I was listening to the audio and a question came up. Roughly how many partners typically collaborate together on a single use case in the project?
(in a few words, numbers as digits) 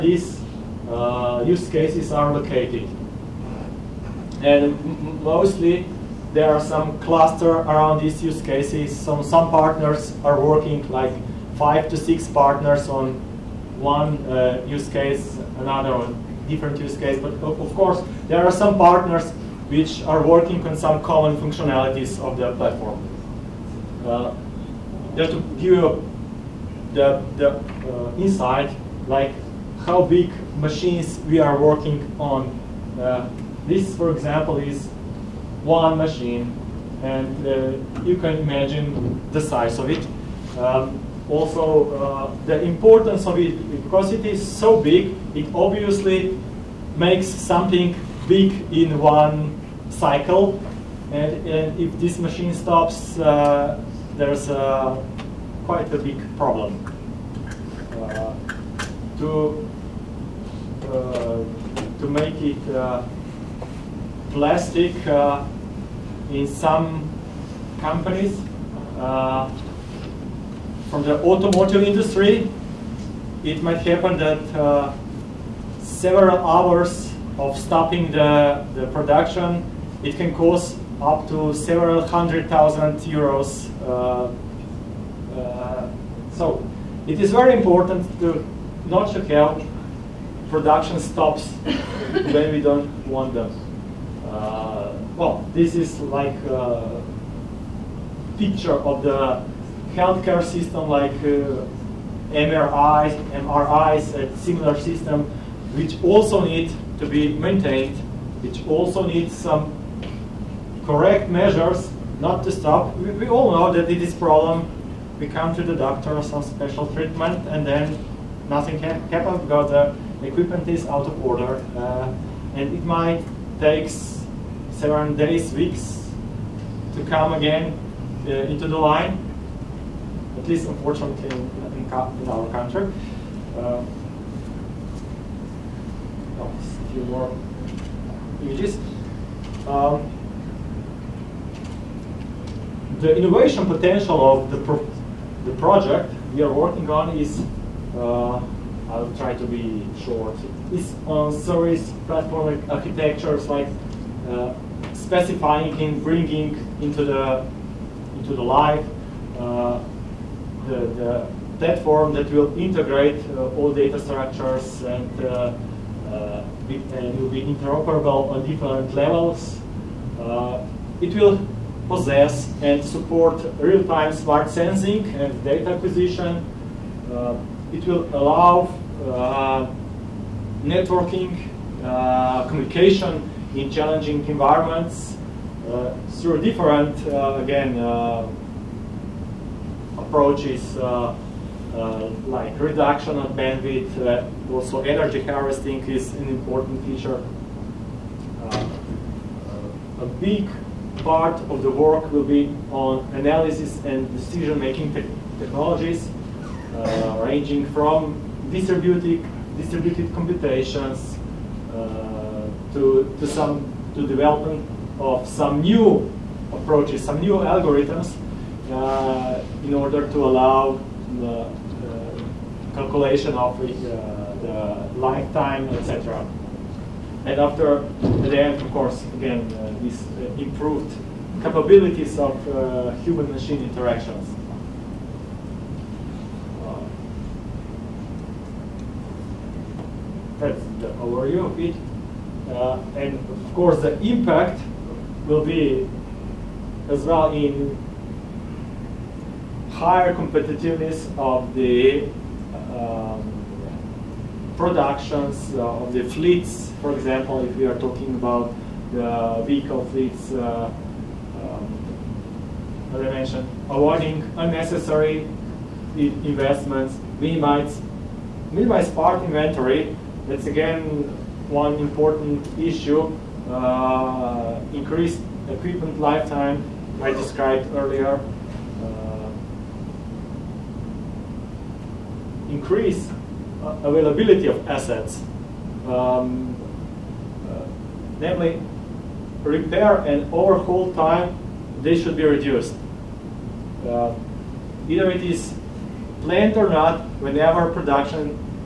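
5 to 6.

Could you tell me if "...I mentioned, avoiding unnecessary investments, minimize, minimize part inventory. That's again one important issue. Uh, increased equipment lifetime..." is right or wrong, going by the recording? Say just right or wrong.
right.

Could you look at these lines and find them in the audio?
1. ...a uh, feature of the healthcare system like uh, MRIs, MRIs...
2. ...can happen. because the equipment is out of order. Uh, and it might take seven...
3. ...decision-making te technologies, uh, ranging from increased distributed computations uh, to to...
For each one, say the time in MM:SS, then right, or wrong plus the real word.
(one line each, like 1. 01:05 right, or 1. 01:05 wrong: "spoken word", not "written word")
1. 01:36 wrong: "picture", not "feature"
2. 01:58 right
3. 03:24 wrong: "distributed", not "increased".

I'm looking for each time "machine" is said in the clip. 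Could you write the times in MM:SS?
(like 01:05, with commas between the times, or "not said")
00:30, 00:35, 00:52, 03:53.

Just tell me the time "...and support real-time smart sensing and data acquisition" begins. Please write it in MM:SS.
02:52.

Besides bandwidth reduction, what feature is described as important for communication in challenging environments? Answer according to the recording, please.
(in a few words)
energy harvesting.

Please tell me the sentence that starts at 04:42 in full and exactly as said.
increase uh, availability of assets, um, uh, namely repair and overhaul time, they should be reduced.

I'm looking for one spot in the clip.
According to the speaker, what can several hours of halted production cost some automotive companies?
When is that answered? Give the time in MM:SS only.
01:21.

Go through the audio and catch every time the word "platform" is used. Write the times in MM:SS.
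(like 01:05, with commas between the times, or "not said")
00:22, 02:32, 02:41.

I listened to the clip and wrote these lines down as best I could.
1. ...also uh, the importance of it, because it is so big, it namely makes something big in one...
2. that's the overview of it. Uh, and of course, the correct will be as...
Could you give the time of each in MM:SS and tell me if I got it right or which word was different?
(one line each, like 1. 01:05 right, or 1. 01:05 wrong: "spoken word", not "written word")
1. 00:41 wrong: "obviously", not "namely"
2. 04:00 wrong: "impact", not "correct".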